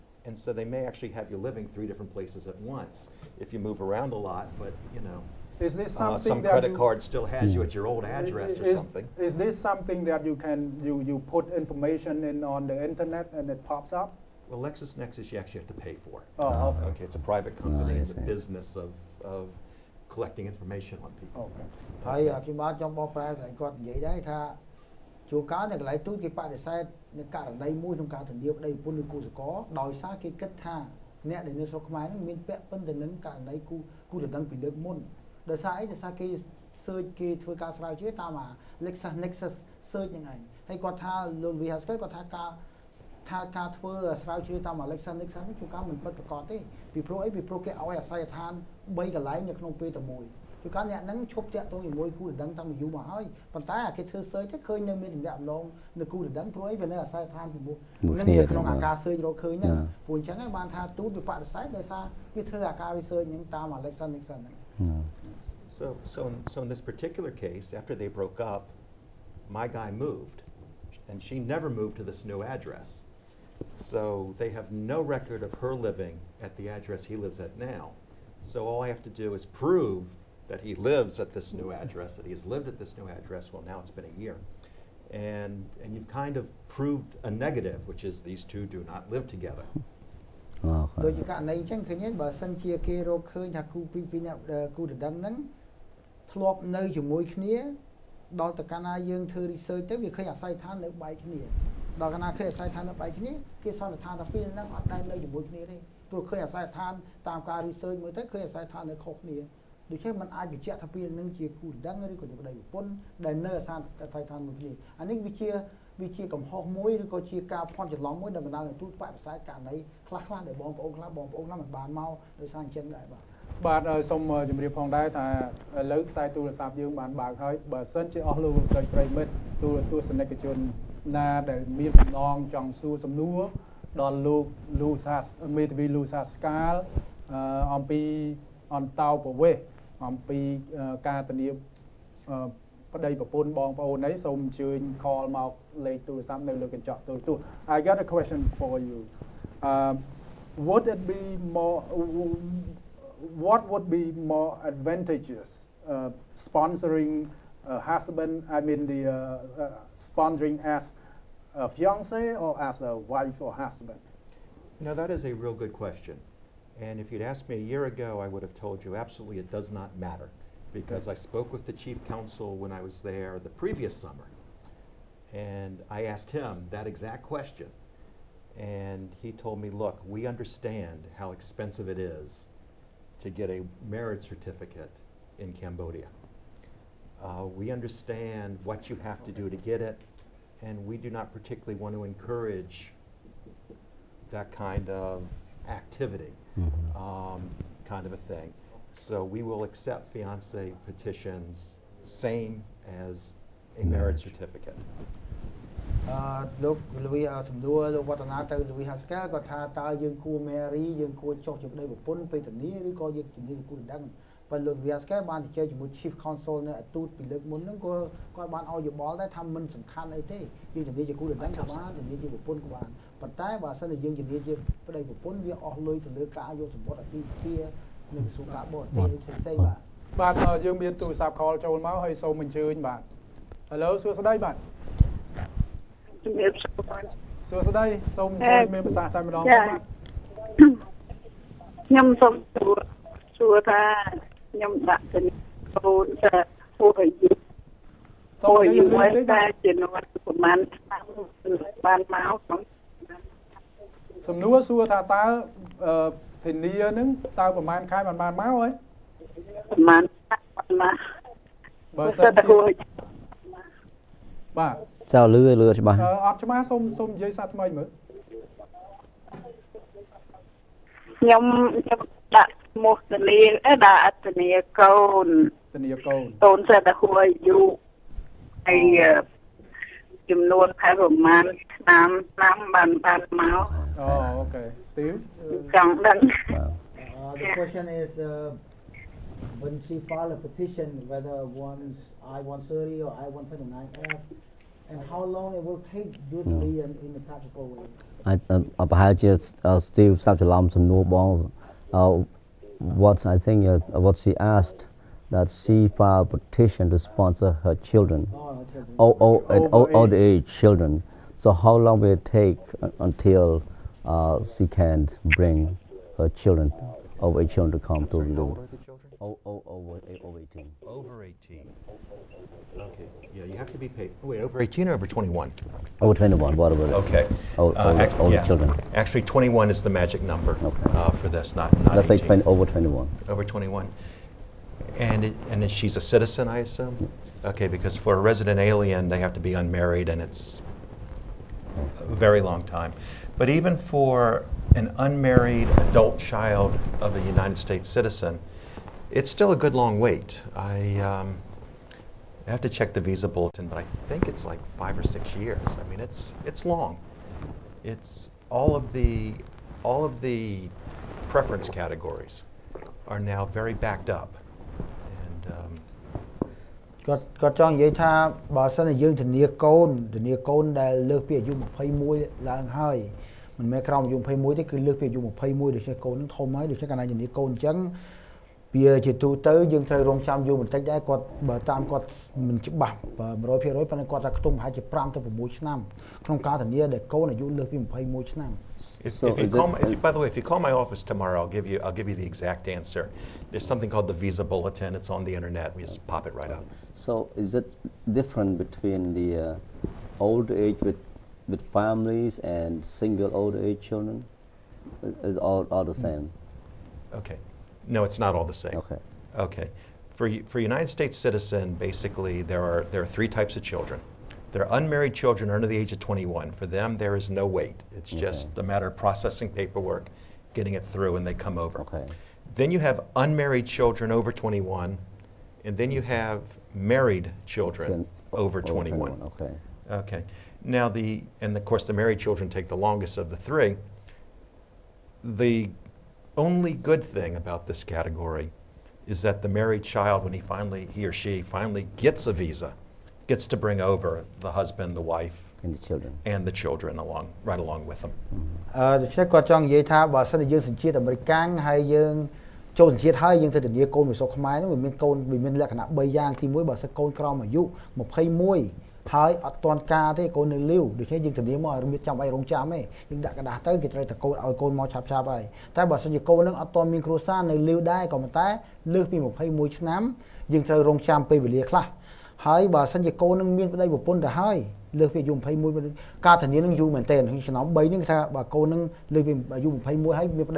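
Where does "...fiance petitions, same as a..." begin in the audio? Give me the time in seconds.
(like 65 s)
200 s.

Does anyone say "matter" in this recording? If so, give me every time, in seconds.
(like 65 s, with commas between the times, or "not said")
169 s, 418 s.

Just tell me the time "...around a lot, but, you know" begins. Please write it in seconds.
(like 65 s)
3 s.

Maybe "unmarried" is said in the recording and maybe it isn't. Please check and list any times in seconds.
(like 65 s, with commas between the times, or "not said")
339 s, 344 s, 414 s, 423 s.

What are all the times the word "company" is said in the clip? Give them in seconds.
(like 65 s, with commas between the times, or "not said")
17 s.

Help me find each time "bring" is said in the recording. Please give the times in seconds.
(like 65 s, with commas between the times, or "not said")
315 s, 443 s.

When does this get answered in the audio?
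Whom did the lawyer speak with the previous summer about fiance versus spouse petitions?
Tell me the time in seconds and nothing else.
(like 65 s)
171 s.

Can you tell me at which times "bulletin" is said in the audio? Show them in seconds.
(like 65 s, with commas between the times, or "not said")
353 s, 394 s.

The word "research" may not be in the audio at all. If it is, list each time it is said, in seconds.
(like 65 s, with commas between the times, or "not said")
62 s, 99 s, 107 s.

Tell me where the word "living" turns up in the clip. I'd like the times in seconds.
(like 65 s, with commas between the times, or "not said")
1 s, 75 s.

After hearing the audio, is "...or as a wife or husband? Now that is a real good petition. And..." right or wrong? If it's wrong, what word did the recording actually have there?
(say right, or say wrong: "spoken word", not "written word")
wrong: "question", not "petition".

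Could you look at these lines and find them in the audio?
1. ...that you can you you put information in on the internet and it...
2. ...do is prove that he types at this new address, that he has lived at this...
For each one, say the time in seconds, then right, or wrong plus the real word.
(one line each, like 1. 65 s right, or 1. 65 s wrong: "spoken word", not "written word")
1. 10 s right
2. 79 s wrong: "lives", not "types".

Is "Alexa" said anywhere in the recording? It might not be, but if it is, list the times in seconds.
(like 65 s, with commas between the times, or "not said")
44 s, 63 s.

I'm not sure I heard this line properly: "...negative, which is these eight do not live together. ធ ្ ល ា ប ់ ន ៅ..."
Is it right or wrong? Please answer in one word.
wrong.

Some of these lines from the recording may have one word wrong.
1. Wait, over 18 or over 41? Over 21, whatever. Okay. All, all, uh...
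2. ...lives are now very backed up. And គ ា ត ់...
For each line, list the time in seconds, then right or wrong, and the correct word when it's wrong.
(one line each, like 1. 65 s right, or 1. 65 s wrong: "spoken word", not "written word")
1. 324 s wrong: "21", not "41"
2. 361 s wrong: "categories", not "lives".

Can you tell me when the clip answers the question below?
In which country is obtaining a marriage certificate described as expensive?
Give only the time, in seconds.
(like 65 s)
185 s.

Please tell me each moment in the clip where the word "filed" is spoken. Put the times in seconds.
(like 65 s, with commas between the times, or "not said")
290 s, 305 s.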